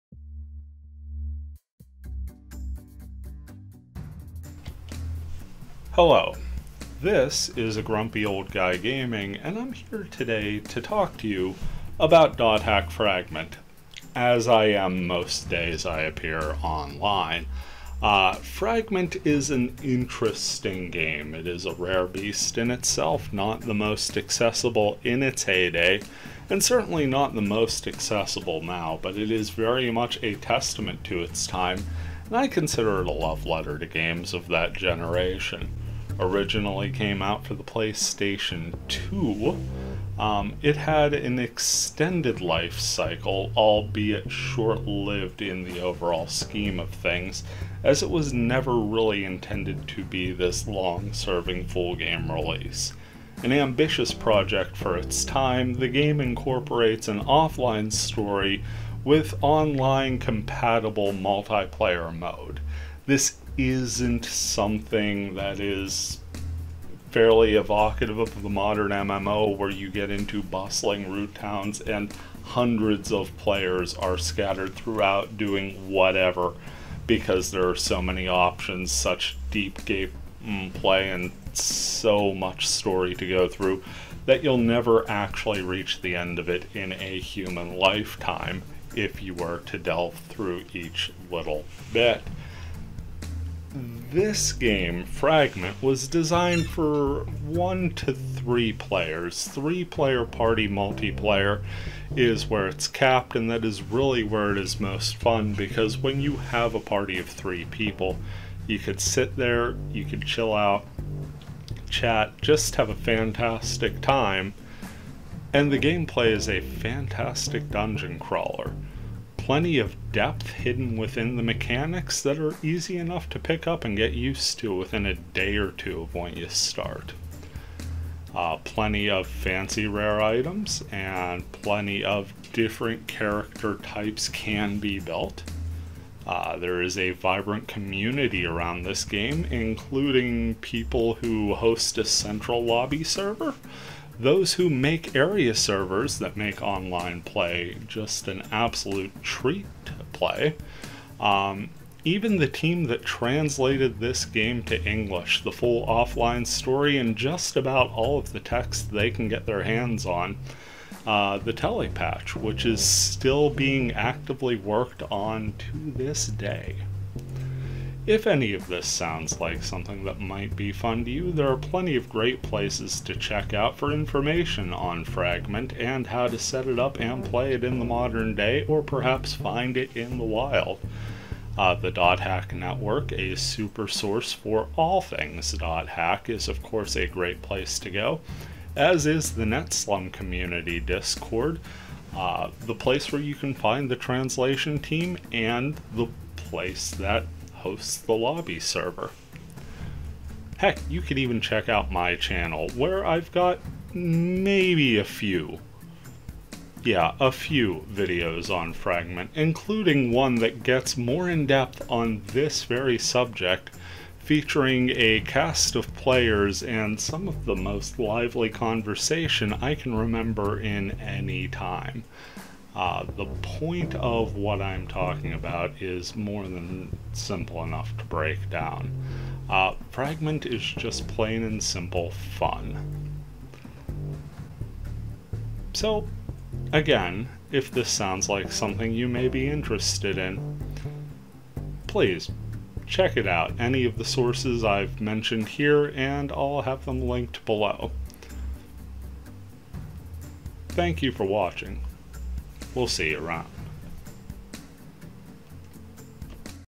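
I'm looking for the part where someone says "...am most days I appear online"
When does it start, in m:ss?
0:14.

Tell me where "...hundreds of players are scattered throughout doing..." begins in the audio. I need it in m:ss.
1:12.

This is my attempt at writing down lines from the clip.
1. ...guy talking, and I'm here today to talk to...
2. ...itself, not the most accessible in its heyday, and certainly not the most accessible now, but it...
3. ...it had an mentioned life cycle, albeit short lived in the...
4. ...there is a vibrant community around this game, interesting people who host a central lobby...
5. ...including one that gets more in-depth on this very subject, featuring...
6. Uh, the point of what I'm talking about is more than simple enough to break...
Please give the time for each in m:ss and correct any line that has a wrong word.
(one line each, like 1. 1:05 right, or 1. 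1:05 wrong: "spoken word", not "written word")
1. 0:08 wrong: "gaming", not "talking"
2. 0:22 right
3. 0:40 wrong: "extended", not "mentioned"
4. 2:16 wrong: "including", not "interesting"
5. 3:29 right
6. 3:42 right.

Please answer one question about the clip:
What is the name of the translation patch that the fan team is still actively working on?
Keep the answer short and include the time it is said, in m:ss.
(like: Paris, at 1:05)
telepatch, at 2:41.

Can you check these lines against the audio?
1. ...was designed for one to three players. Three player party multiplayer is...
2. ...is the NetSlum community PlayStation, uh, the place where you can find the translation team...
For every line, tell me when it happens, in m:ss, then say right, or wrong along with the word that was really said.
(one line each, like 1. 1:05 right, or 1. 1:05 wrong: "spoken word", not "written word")
1. 1:35 right
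2. 3:09 wrong: "Discord", not "PlayStation".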